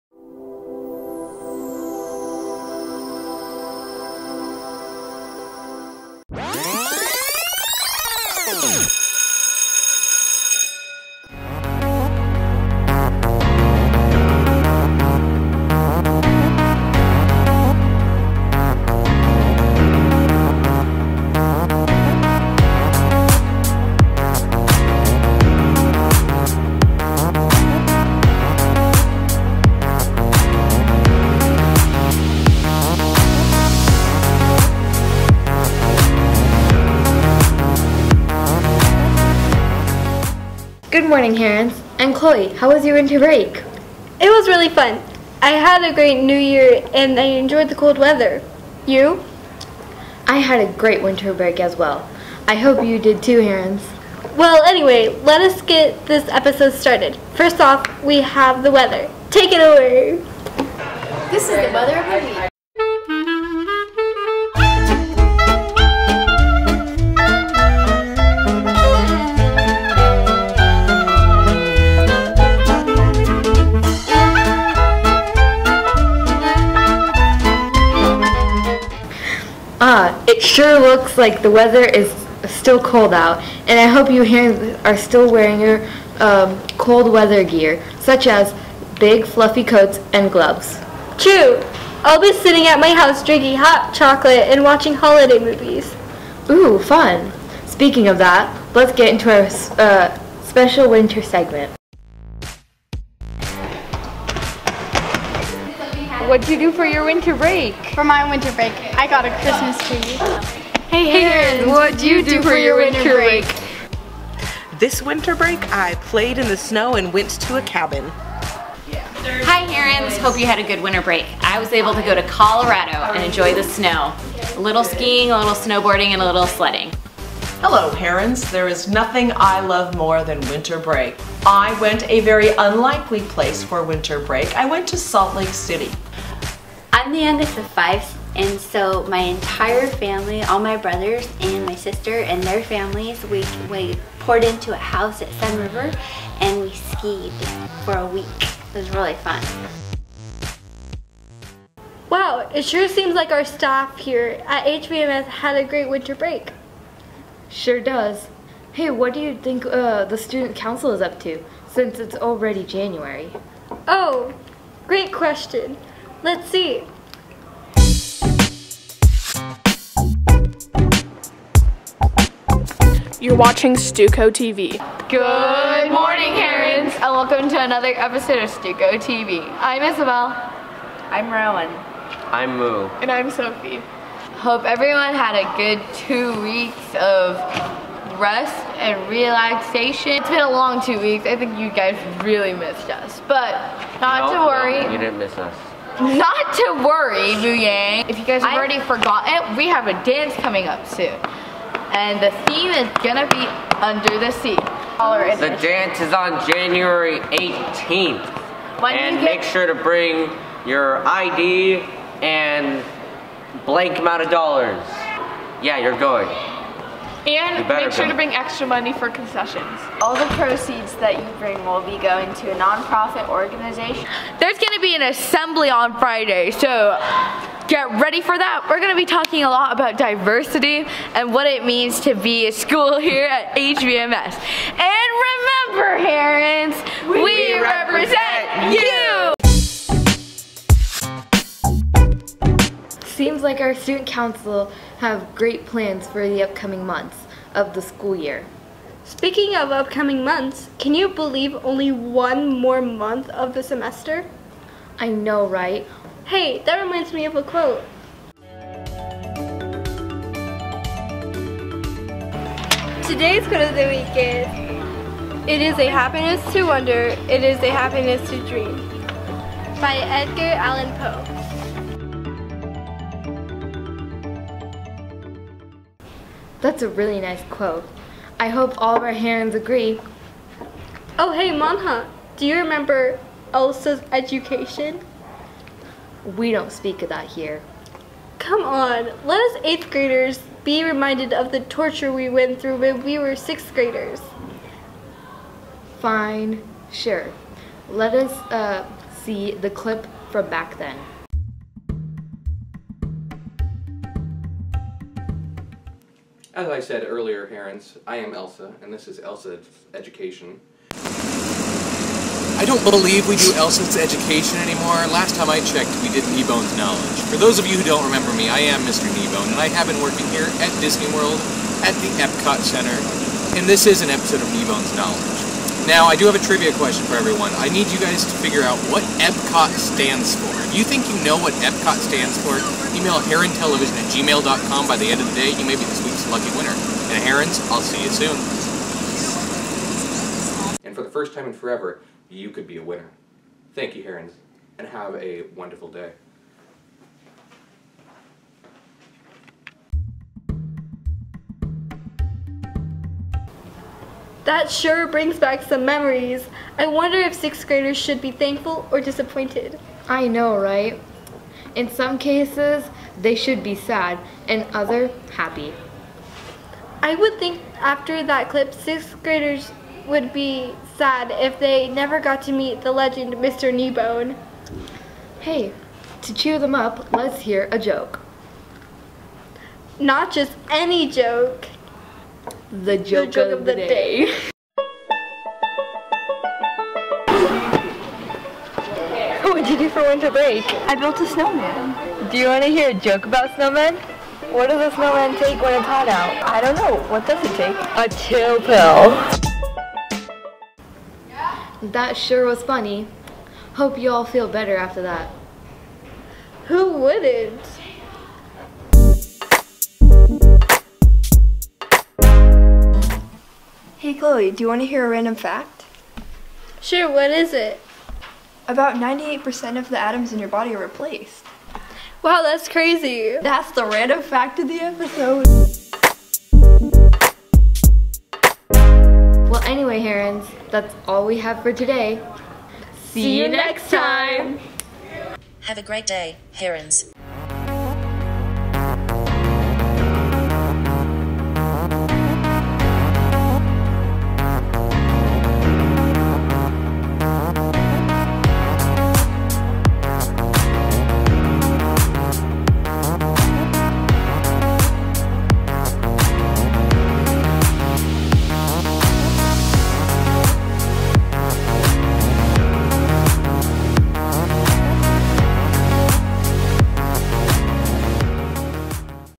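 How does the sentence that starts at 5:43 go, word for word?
Thank you, herons, and have a wonderful day.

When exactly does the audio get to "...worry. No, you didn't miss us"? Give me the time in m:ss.
3:14.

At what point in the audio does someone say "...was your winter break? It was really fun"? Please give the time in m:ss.
0:42.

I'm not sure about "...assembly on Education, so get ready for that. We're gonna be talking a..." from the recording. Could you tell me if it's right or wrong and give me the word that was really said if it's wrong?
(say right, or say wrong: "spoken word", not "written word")
wrong: "Friday", not "Education".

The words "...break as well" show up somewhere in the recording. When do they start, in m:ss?
0:51.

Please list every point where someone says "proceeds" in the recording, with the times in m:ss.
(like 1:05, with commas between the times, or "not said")
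3:40.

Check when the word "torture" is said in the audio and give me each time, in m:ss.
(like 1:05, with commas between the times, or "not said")
4:51.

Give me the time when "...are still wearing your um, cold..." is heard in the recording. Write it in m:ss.
1:24.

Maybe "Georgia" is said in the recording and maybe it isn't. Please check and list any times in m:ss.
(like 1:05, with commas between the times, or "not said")
not said.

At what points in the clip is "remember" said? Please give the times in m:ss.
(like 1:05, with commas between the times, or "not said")
3:55, 4:42, 5:18.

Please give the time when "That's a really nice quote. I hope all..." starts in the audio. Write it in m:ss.
4:36.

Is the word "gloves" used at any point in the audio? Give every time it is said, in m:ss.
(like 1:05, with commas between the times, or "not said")
1:30.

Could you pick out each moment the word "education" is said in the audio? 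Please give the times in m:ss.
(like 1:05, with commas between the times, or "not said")
4:44, 5:09, 5:13.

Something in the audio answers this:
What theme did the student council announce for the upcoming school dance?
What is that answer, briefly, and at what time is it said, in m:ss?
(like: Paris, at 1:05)
Under the Sea, at 3:23.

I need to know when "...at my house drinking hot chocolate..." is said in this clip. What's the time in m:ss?
1:32.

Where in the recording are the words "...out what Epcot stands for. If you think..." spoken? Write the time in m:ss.
5:28.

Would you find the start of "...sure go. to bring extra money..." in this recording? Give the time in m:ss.
3:37.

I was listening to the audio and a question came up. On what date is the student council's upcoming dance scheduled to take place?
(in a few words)
January 18th.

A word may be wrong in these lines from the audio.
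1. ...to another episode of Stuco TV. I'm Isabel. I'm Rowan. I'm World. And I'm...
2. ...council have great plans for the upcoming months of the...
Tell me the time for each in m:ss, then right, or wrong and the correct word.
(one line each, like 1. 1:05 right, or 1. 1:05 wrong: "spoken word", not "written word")
1. 2:57 wrong: "Moo", not "World"
2. 4:04 right.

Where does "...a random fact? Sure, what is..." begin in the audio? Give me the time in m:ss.
6:55.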